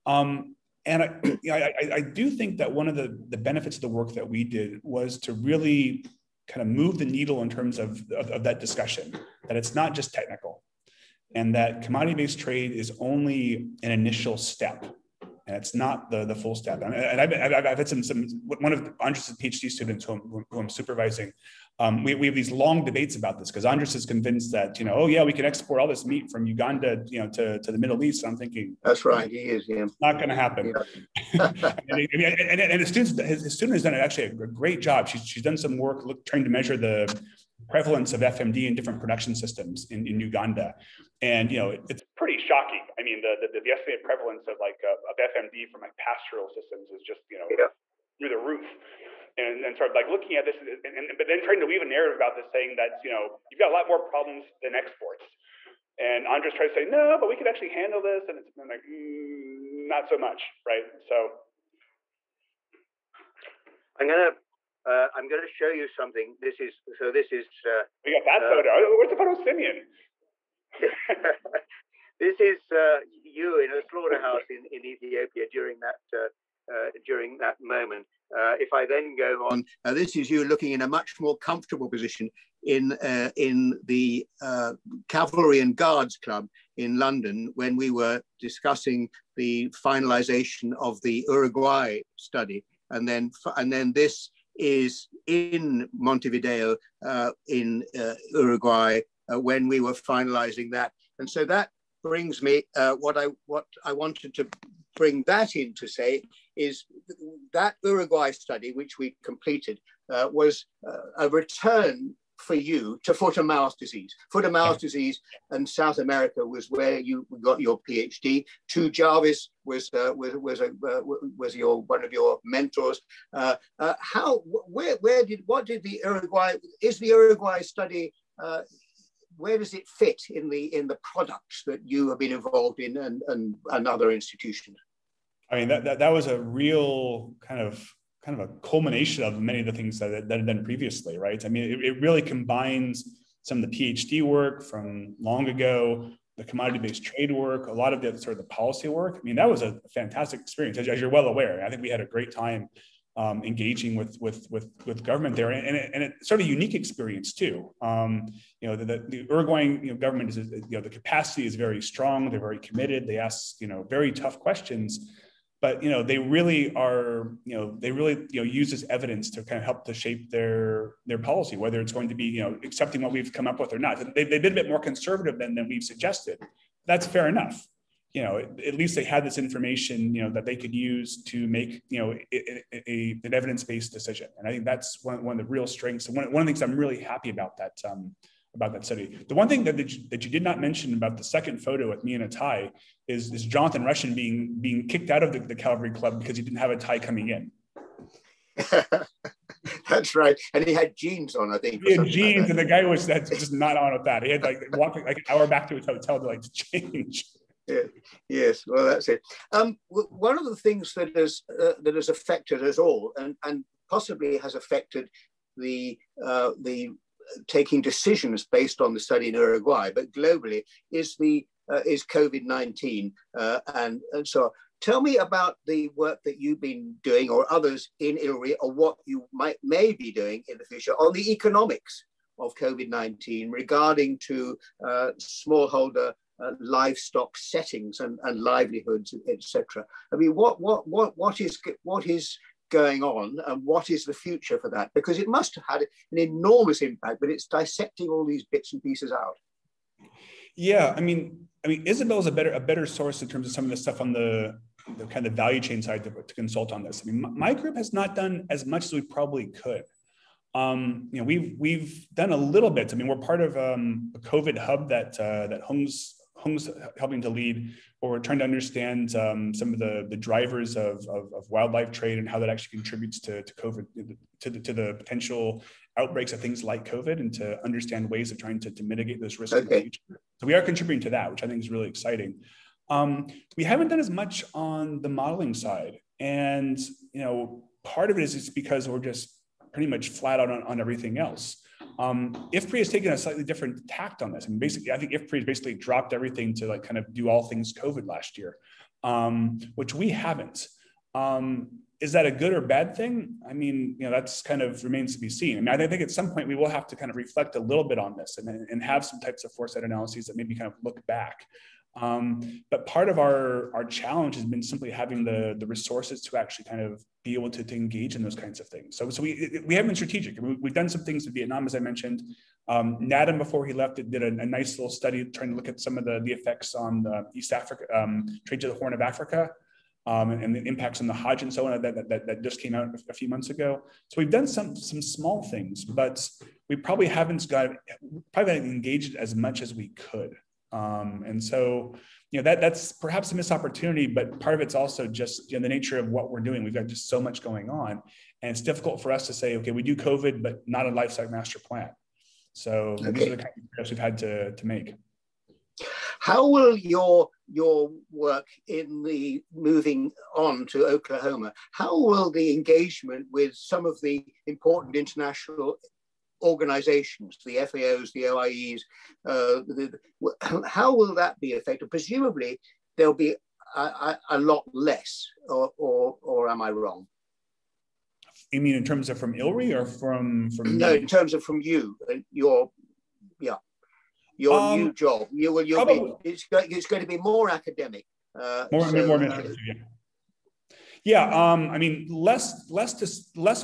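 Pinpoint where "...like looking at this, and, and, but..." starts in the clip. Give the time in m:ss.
0:49.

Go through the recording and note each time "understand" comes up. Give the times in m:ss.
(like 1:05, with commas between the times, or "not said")
4:28, 4:37.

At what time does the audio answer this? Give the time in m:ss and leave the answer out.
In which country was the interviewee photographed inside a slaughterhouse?
1:14.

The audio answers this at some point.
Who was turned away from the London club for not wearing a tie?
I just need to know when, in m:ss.
3:13.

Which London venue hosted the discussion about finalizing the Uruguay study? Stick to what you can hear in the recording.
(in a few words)
Cavalry and Guards Club.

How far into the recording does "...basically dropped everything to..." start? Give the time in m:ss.
4:55.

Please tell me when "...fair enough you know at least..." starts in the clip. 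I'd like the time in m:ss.
2:57.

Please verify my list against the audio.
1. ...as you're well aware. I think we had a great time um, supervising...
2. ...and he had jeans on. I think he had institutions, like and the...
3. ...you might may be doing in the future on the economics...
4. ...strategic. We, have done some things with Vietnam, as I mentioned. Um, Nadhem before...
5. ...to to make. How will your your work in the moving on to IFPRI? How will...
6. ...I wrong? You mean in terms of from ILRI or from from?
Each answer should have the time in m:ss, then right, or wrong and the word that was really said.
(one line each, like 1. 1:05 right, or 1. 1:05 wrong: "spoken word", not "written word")
1. 2:30 wrong: "engaging", not "supervising"
2. 3:20 wrong: "jeans", not "institutions"
3. 3:49 right
4. 5:19 right
5. 5:54 wrong: "Oklahoma", not "IFPRI"
6. 6:16 right.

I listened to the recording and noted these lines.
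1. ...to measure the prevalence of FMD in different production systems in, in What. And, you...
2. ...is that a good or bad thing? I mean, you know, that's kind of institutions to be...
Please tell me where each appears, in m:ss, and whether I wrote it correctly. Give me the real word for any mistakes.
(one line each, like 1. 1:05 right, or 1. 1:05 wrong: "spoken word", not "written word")
1. 0:36 wrong: "Uganda", not "What"
2. 5:02 wrong: "remains", not "institutions".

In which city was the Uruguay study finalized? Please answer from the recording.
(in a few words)
Montevideo.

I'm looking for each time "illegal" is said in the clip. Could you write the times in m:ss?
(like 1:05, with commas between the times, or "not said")
not said.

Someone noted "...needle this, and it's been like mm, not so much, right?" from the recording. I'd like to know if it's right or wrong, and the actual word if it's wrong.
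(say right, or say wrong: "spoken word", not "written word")
wrong: "handle", not "needle".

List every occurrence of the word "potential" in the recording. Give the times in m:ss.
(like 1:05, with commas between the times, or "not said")
4:34.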